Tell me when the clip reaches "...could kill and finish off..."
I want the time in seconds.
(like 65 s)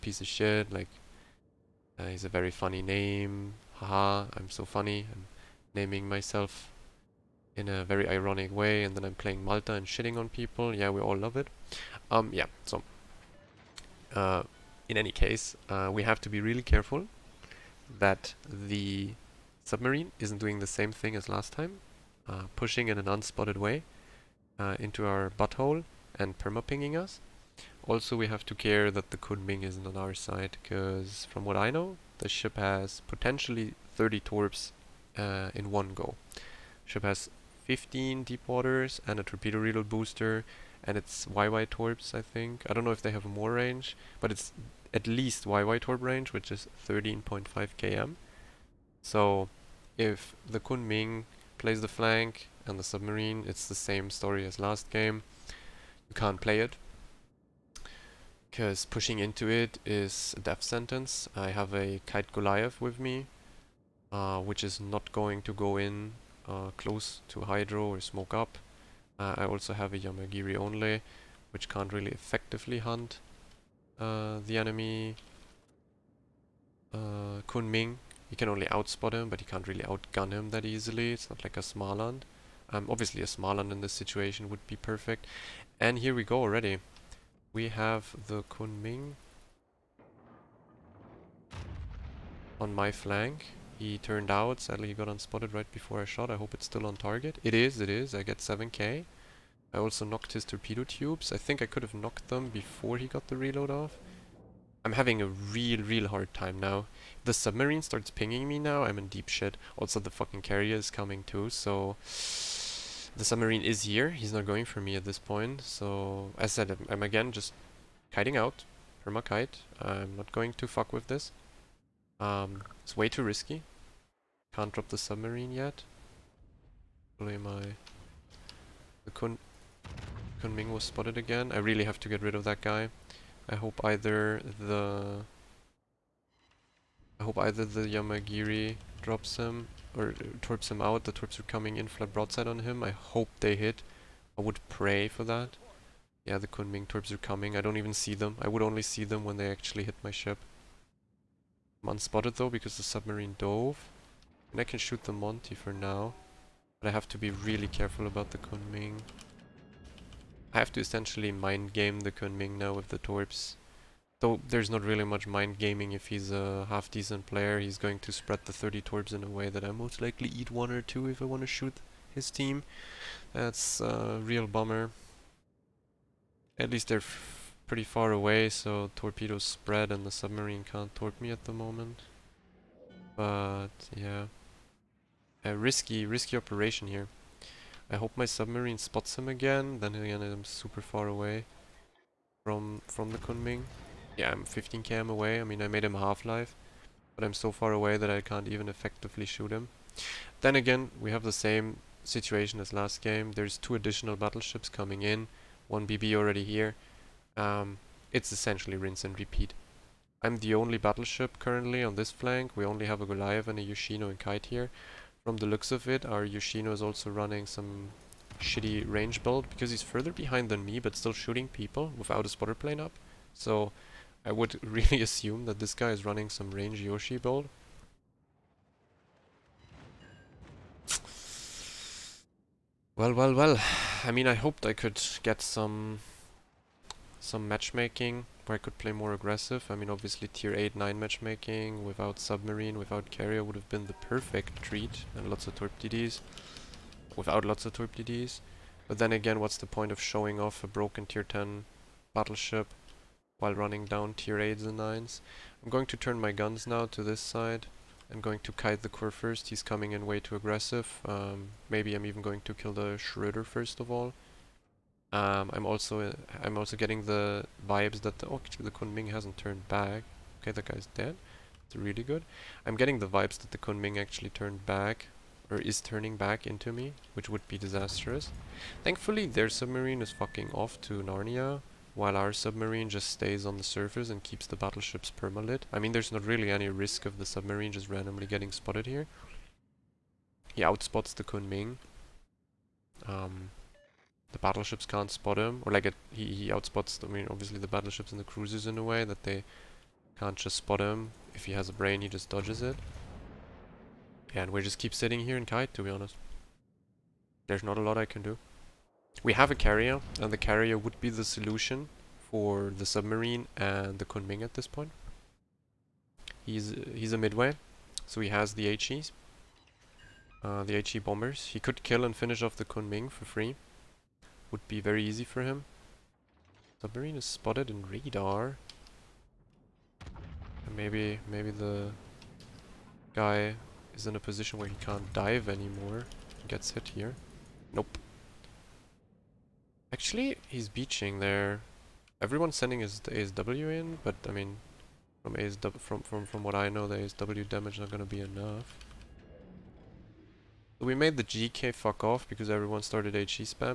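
321 s.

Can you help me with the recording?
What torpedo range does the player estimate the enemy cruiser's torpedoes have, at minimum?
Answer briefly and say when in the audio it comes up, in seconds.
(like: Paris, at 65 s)
13.5 km, at 46 s.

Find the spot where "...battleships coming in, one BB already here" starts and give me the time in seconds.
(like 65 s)
204 s.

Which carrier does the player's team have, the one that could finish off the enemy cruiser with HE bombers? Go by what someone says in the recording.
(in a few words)
Midway.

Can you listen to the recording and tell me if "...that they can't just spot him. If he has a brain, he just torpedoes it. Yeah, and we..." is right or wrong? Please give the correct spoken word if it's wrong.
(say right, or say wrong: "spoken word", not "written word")
wrong: "dodges", not "torpedoes".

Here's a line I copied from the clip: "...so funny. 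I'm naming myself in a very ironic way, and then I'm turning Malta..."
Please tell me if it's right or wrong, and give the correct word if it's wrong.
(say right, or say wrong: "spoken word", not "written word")
wrong: "playing", not "turning".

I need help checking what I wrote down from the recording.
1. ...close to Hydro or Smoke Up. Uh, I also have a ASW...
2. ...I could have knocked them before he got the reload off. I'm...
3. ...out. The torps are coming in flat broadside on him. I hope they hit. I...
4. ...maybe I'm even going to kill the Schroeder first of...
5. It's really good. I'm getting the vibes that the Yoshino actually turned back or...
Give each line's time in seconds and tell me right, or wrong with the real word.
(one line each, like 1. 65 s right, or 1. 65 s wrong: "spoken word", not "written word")
1. 66 s wrong: "Yamagiri", not "ASW"
2. 101 s right
3. 140 s right
4. 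261 s right
5. 271 s wrong: "Kunming", not "Yoshino".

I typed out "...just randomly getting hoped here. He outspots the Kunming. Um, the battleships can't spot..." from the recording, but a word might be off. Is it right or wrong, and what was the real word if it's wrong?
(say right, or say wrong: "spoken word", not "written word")
wrong: "spotted", not "hoped".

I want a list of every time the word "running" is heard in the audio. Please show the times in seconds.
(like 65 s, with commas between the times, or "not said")
217 s, 226 s, 253 s.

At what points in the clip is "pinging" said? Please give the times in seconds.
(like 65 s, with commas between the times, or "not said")
26 s, 108 s.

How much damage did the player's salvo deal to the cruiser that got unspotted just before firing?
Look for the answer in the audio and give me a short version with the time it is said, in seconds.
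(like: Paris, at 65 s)
7k, at 98 s.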